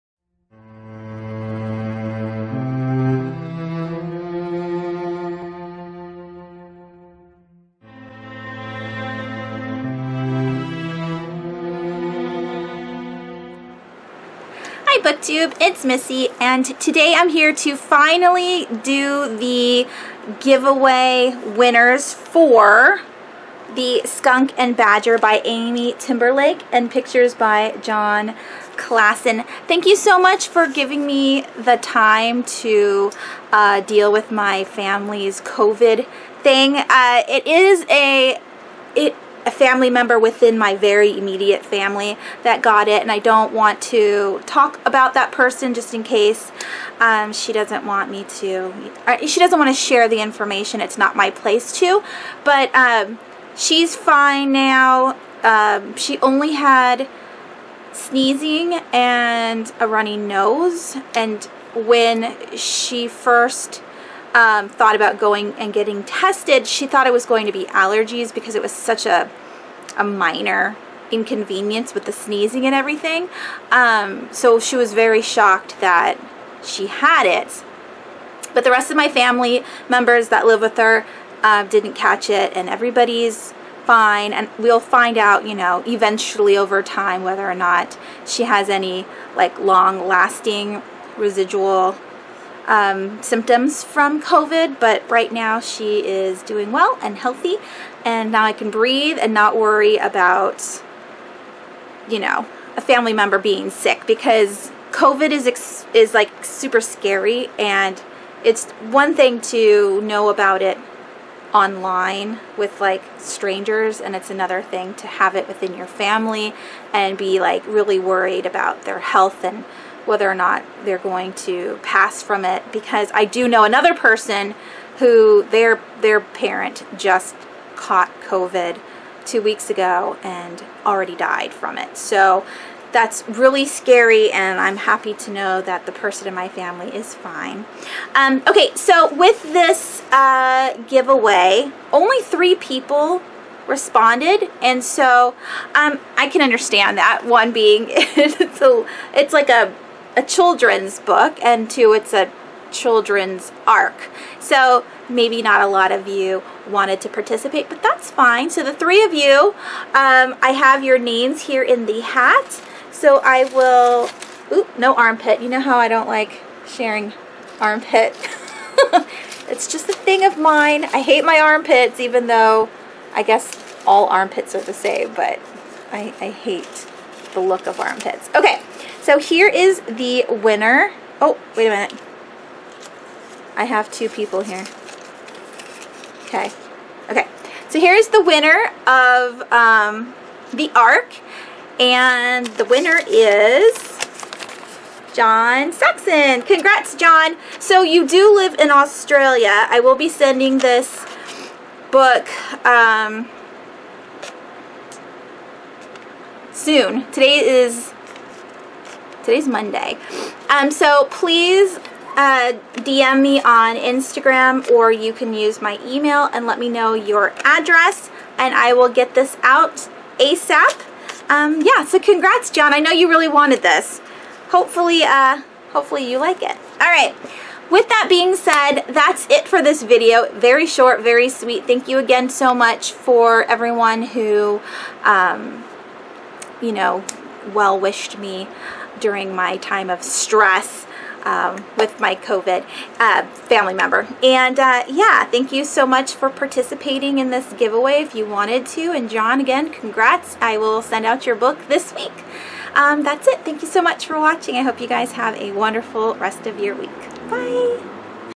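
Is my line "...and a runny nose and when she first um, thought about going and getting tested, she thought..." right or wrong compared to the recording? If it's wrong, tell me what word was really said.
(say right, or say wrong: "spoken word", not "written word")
right.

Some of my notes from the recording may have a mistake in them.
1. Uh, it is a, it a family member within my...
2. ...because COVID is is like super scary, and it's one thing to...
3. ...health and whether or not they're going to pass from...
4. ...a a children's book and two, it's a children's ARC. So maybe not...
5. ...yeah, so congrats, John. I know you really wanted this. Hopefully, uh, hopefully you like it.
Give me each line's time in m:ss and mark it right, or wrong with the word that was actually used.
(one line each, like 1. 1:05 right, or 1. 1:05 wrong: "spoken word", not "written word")
1. 0:36 right
2. 1:44 right
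3. 1:58 right
4. 2:29 right
5. 3:41 right.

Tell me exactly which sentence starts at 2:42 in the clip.
So I will, oop, no armpit.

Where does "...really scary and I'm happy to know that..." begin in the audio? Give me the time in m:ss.
2:13.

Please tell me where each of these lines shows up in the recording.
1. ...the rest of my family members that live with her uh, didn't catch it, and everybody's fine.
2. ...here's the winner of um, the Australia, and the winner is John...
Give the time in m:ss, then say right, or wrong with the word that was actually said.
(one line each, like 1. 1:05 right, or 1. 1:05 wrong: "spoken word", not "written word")
1. 1:18 right
2. 3:07 wrong: "ARC", not "Australia".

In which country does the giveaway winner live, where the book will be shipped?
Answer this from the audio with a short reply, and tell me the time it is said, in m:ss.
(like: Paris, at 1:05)
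Australia, at 3:18.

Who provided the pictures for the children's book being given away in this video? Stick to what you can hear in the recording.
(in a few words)
Jon Klassen.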